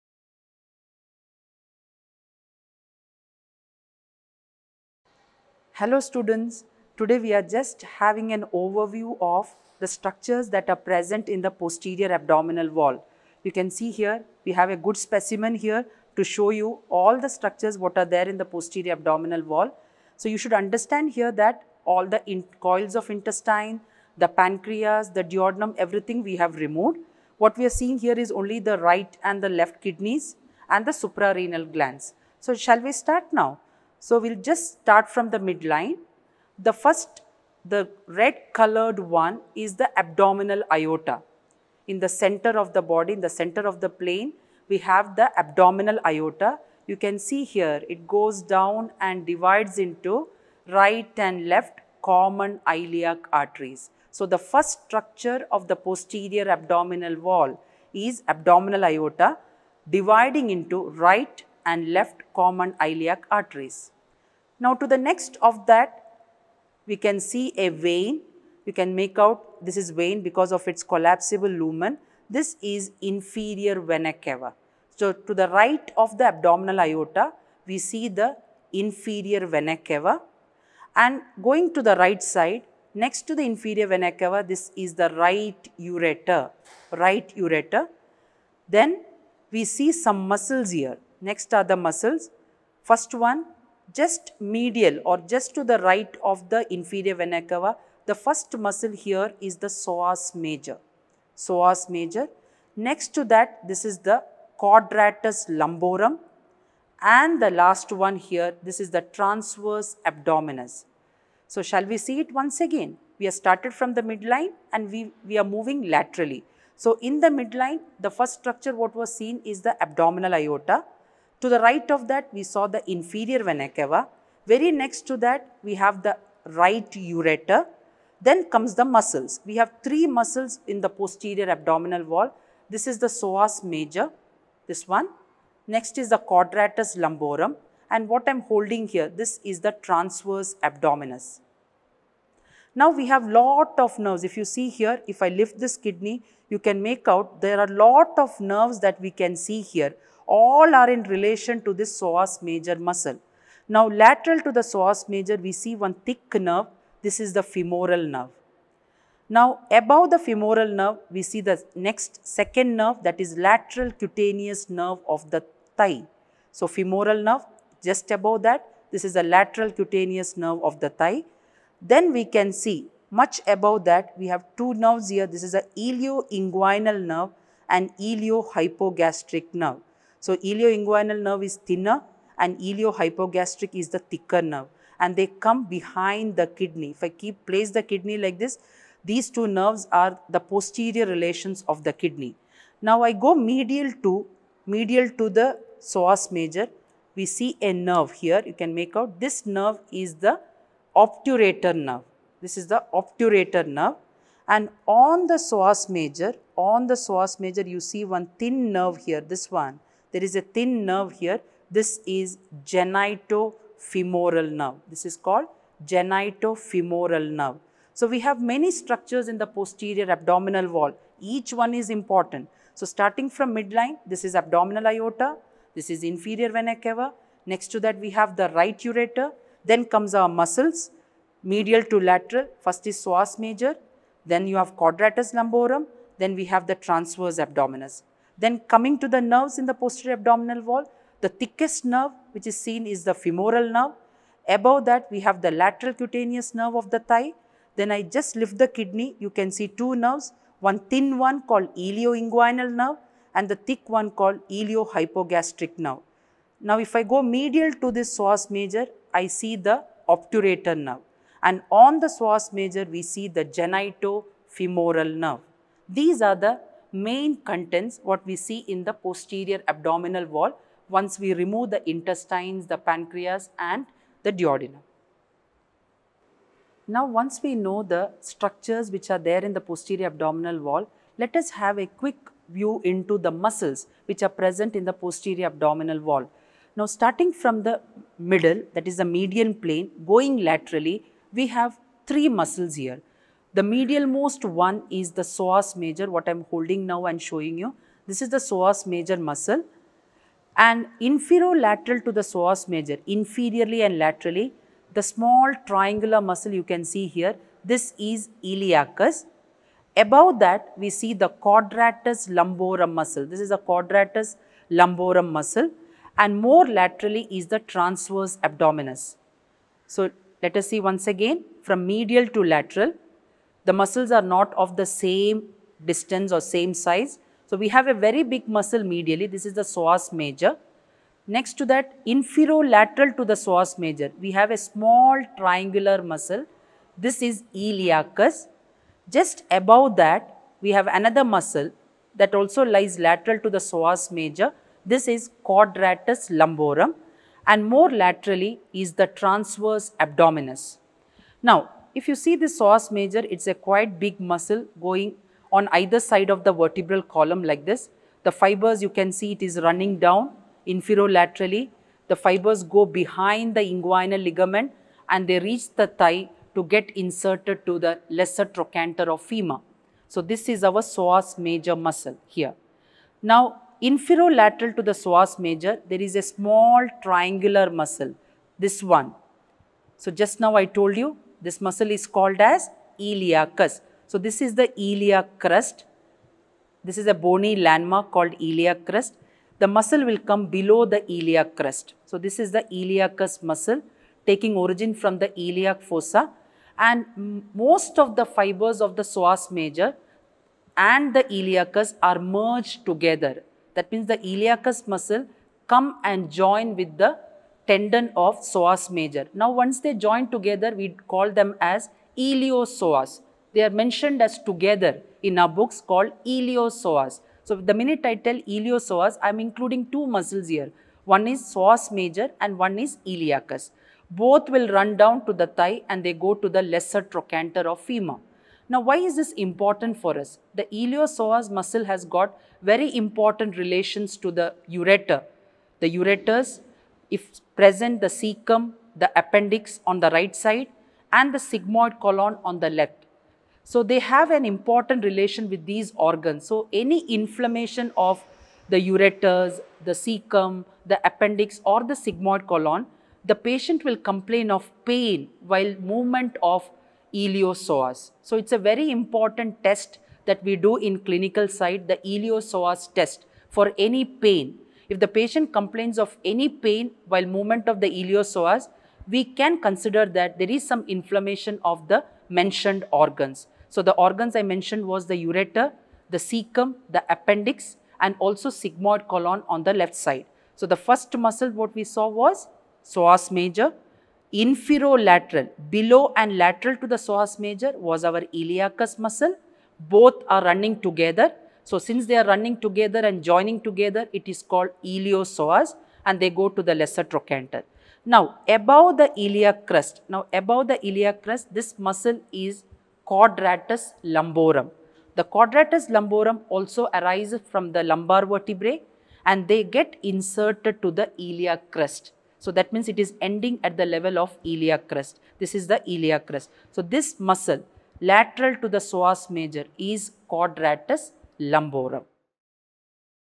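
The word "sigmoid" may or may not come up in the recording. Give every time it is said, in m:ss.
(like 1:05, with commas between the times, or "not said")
7:21, 7:32, 7:58.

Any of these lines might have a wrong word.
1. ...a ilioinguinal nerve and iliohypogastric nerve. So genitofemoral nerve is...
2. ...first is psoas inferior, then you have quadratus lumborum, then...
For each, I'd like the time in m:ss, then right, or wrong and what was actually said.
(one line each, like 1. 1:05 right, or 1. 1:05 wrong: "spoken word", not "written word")
1. 2:55 wrong: "ilioinguinal", not "genitofemoral"
2. 3:52 wrong: "major", not "inferior".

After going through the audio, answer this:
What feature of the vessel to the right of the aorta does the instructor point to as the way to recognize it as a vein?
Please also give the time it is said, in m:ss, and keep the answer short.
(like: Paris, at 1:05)
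Collapsible lumen, at 1:10.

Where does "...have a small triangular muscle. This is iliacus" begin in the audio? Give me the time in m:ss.
5:34.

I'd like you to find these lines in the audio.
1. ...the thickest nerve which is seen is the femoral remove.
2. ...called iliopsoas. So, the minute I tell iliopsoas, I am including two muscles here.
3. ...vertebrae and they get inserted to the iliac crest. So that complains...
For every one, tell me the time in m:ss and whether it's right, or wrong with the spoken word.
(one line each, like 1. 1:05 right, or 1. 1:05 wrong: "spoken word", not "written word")
1. 4:01 wrong: "nerve", not "remove"
2. 6:55 right
3. 8:28 wrong: "means", not "complains".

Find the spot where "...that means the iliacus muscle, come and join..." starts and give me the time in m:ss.
6:43.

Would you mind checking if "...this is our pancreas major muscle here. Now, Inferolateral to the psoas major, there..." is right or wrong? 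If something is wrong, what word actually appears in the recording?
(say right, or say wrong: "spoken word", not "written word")
wrong: "psoas", not "pancreas".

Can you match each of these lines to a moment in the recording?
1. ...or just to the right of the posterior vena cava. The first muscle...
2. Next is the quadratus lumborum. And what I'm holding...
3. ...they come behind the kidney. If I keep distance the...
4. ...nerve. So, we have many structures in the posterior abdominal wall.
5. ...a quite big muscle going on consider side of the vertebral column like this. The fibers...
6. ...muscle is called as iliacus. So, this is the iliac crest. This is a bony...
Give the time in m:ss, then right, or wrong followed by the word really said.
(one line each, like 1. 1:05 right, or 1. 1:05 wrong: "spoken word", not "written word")
1. 1:35 wrong: "inferior", not "posterior"
2. 2:15 right
3. 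3:05 wrong: "place", not "distance"
4. 3:37 right
5. 5:53 wrong: "either", not "consider"
6. 6:21 right.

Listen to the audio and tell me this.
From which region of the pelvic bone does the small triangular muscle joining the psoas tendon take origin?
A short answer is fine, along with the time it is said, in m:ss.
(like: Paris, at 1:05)
Iliac fossa, at 6:35.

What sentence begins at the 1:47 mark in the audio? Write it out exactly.
And the last one here, this is the transverse abdominis.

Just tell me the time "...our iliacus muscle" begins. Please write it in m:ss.
8:08.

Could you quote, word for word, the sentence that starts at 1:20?
And going to the right side, next to the inferior vena cava, this is the right ureter, right ureter.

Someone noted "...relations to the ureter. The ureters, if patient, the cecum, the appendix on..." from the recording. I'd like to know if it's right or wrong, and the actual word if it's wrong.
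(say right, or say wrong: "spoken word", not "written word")
wrong: "present", not "patient".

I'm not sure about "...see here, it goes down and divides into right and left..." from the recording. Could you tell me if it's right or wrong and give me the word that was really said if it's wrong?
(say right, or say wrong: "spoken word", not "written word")
right.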